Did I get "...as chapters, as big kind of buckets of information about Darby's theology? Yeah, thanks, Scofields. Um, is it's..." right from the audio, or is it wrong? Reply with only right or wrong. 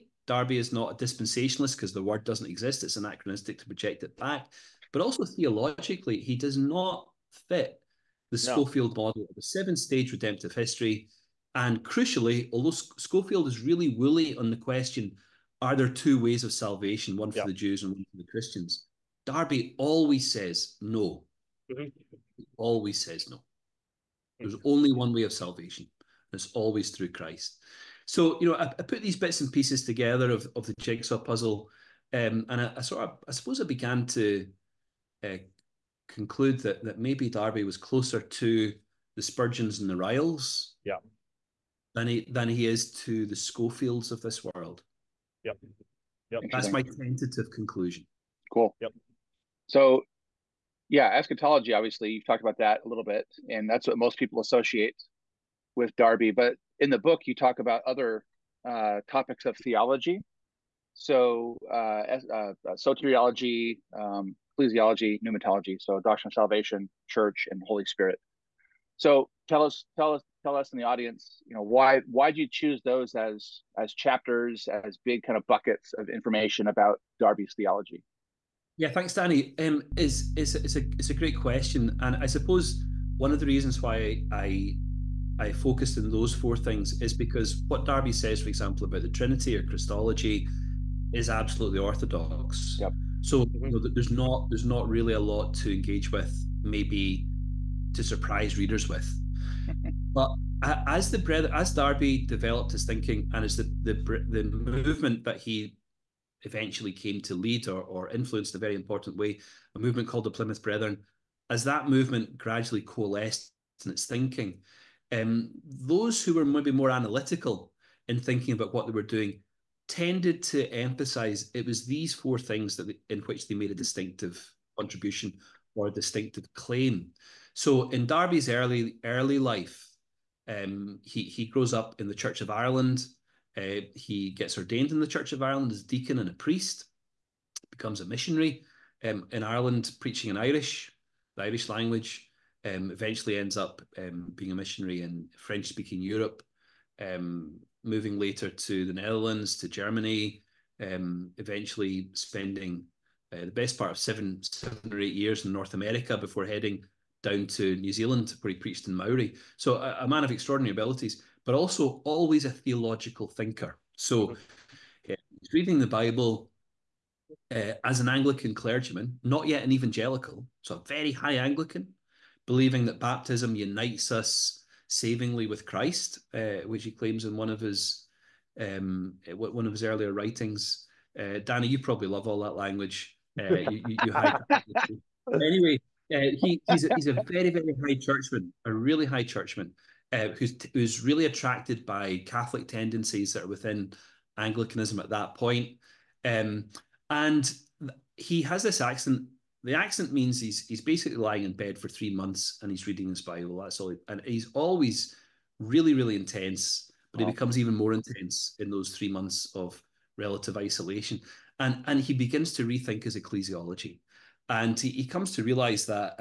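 wrong.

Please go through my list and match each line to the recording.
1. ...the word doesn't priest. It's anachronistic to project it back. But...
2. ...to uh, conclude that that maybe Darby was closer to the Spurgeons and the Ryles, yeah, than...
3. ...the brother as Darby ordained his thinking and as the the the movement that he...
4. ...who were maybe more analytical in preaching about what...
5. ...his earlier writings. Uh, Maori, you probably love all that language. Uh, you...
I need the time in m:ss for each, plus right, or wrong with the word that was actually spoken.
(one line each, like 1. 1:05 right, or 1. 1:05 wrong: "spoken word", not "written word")
1. 0:01 wrong: "exist", not "priest"
2. 0:34 right
3. 1:41 wrong: "developed", not "ordained"
4. 1:56 wrong: "thinking", not "preaching"
5. 2:59 wrong: "Danny", not "Maori".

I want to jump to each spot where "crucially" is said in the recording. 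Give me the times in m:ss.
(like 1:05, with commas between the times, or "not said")
0:11.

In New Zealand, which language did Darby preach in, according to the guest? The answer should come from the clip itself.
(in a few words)
Maori.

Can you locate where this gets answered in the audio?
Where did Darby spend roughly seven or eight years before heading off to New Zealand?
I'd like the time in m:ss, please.
2:35.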